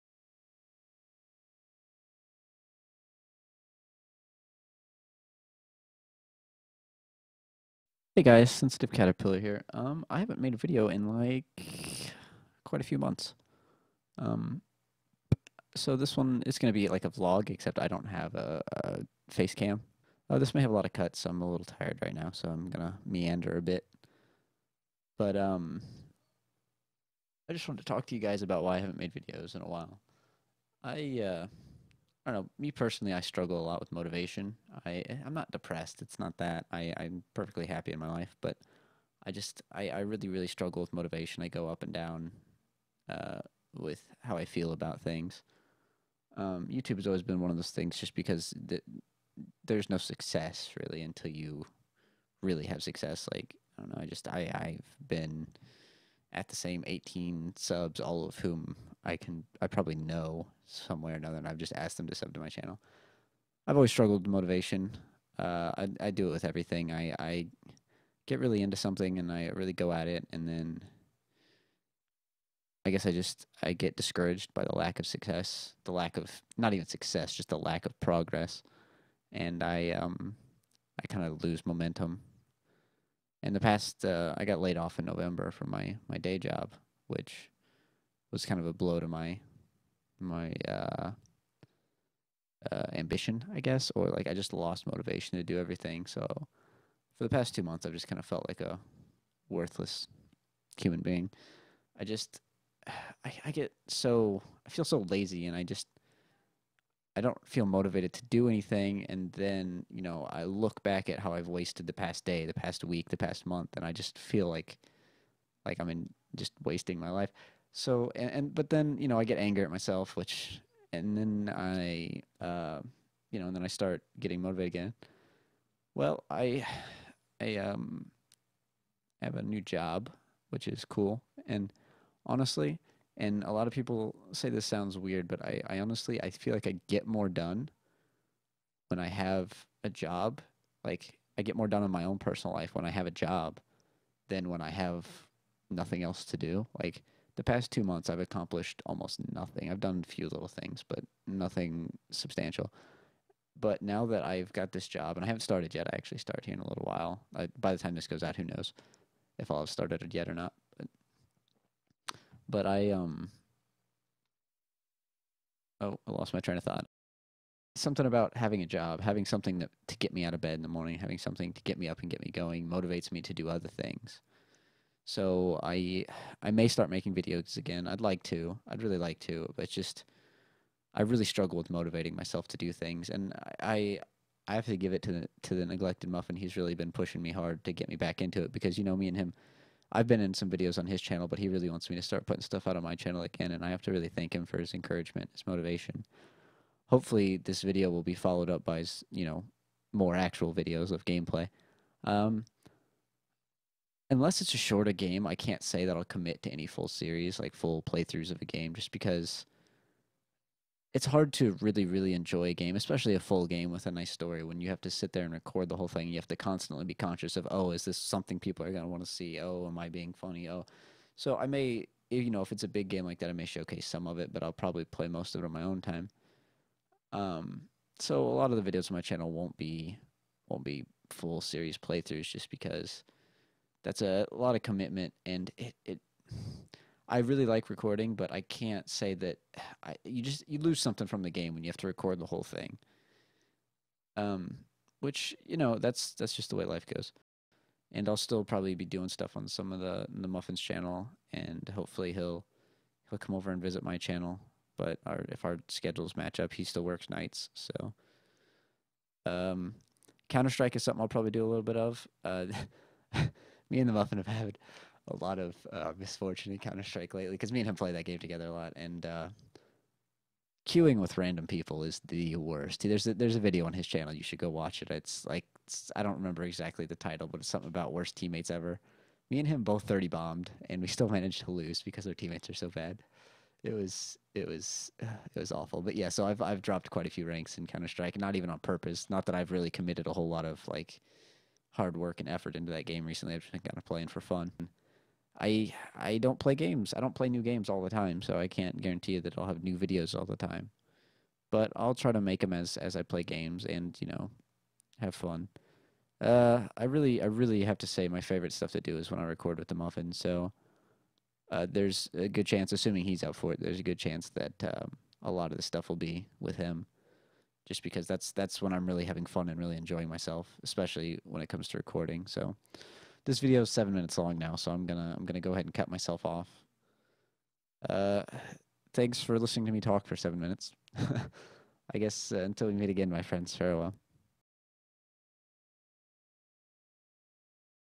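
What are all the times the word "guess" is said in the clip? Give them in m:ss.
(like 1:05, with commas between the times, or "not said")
1:12, 1:33, 5:31.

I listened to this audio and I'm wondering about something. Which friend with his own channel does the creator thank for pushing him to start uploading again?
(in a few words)
The Neglected Muffin.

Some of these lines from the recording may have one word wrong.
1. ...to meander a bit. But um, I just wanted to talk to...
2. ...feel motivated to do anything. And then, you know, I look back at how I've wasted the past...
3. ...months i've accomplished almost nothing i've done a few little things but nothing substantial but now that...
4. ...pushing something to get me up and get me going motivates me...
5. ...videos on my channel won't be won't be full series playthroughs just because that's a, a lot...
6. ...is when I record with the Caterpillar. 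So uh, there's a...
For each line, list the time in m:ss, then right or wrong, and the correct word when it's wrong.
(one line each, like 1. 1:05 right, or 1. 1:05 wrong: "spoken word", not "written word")
1. 0:22 right
2. 1:47 right
3. 2:27 right
4. 2:50 wrong: "having", not "pushing"
5. 3:48 right
6. 5:08 wrong: "Muffin", not "Caterpillar".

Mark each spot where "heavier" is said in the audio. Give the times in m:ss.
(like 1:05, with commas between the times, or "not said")
not said.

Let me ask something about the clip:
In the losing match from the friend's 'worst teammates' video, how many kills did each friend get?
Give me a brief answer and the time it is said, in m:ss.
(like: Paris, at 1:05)
30, at 4:39.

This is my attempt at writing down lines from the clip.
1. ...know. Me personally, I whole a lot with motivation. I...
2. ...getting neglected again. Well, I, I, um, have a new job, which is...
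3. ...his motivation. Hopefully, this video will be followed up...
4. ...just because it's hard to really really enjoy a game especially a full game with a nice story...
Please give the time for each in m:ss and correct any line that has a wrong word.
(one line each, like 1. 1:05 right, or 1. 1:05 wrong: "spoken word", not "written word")
1. 0:32 wrong: "struggle", not "whole"
2. 2:04 wrong: "motivated", not "neglected"
3. 3:15 right
4. 3:28 right.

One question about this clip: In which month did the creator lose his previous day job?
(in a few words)
November.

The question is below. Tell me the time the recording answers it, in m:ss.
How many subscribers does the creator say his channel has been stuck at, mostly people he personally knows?
0:56.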